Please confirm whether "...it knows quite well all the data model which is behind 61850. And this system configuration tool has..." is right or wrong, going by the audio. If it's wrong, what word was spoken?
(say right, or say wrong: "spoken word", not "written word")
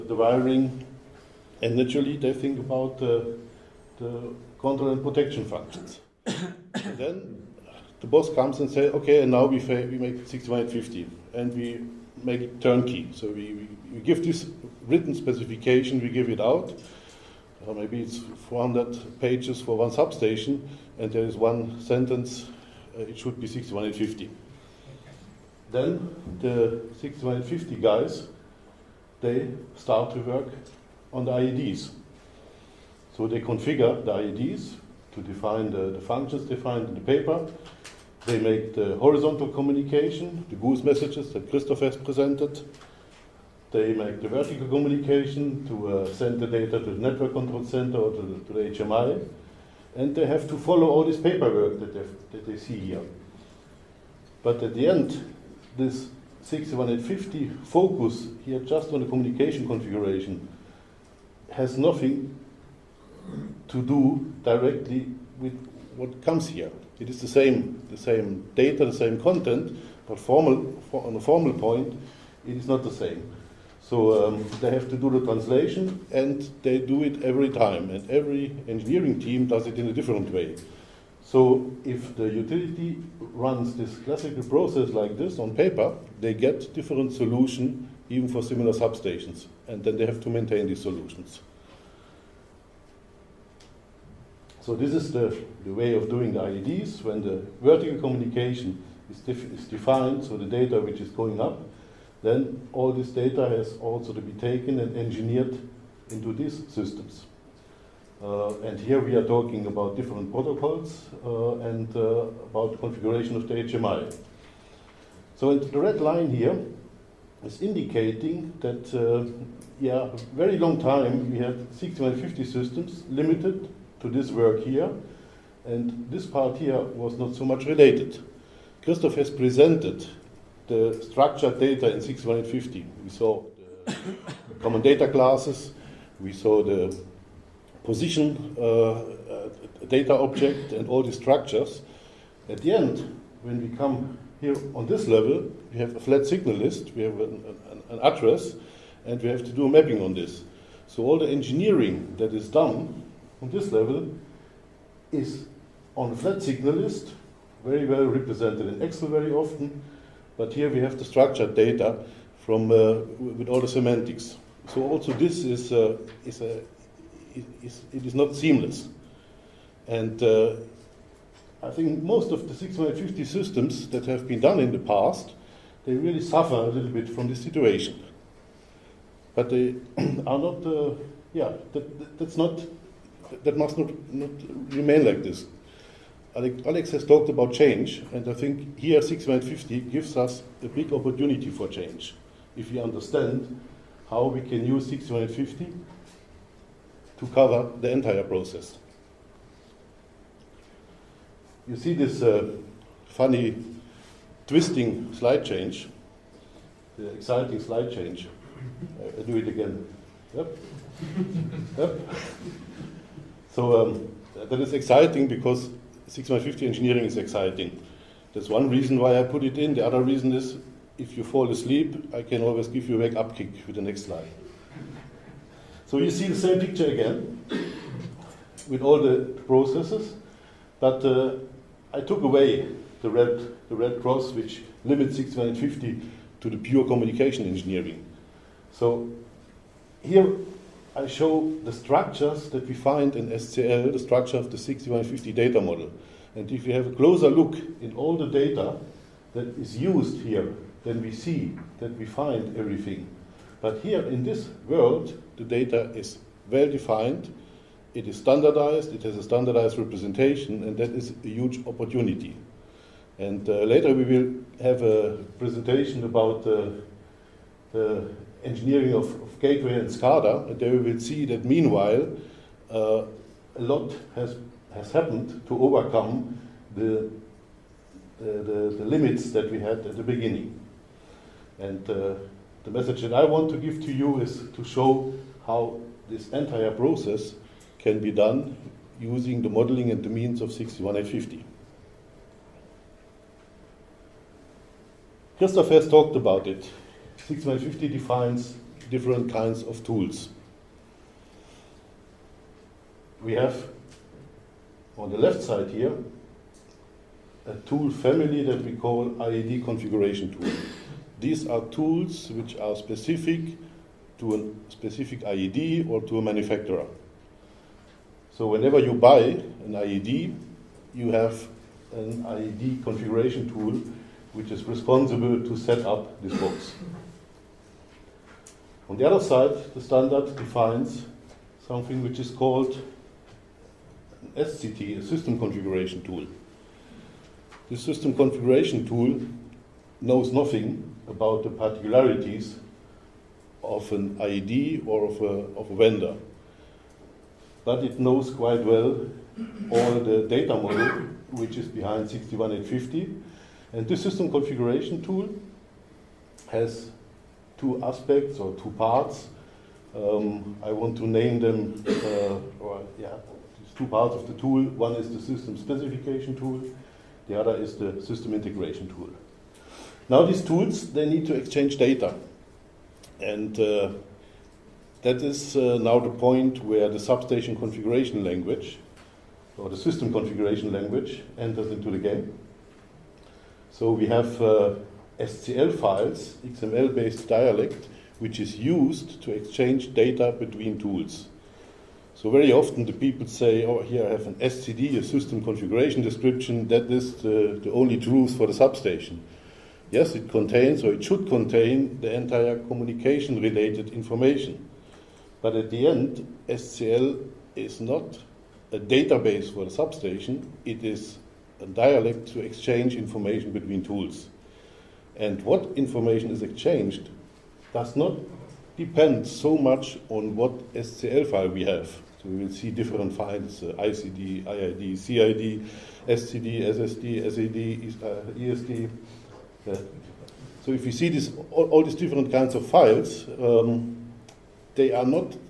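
right.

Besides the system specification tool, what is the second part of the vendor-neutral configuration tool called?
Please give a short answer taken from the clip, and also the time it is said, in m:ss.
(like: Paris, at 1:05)
system integration tool, at 6:08.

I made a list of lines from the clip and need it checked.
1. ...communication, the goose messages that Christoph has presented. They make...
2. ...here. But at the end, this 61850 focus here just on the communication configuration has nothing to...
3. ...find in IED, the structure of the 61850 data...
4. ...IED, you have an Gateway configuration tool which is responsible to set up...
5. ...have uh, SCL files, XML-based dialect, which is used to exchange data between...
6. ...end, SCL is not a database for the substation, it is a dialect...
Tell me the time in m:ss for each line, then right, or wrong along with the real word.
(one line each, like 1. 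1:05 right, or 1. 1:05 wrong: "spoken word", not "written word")
1. 0:39 right
2. 0:52 right
3. 4:02 wrong: "SCL", not "IED"
4. 5:19 wrong: "IED", not "Gateway"
5. 6:24 right
6. 6:45 right.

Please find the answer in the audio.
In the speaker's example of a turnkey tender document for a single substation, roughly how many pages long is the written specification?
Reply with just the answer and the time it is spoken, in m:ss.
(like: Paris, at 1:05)
400, at 0:18.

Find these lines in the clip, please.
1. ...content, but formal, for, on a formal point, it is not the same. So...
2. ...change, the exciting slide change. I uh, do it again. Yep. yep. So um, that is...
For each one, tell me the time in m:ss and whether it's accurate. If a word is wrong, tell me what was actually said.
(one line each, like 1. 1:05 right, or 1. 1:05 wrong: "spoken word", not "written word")
1. 1:09 right
2. 3:25 right.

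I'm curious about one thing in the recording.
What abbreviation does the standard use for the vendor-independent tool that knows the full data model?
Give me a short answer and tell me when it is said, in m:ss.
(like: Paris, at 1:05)
SCT, at 5:34.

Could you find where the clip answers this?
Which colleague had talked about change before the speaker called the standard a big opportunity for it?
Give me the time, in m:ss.
3:06.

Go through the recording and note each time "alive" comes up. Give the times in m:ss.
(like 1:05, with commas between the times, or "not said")
not said.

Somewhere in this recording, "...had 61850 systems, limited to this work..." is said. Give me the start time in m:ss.
2:01.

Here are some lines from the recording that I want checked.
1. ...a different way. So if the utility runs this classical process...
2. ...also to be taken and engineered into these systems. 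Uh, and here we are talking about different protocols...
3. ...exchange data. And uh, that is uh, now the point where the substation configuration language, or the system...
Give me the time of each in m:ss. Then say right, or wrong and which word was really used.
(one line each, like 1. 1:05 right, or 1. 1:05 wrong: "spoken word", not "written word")
1. 1:19 right
2. 1:43 right
3. 6:11 right.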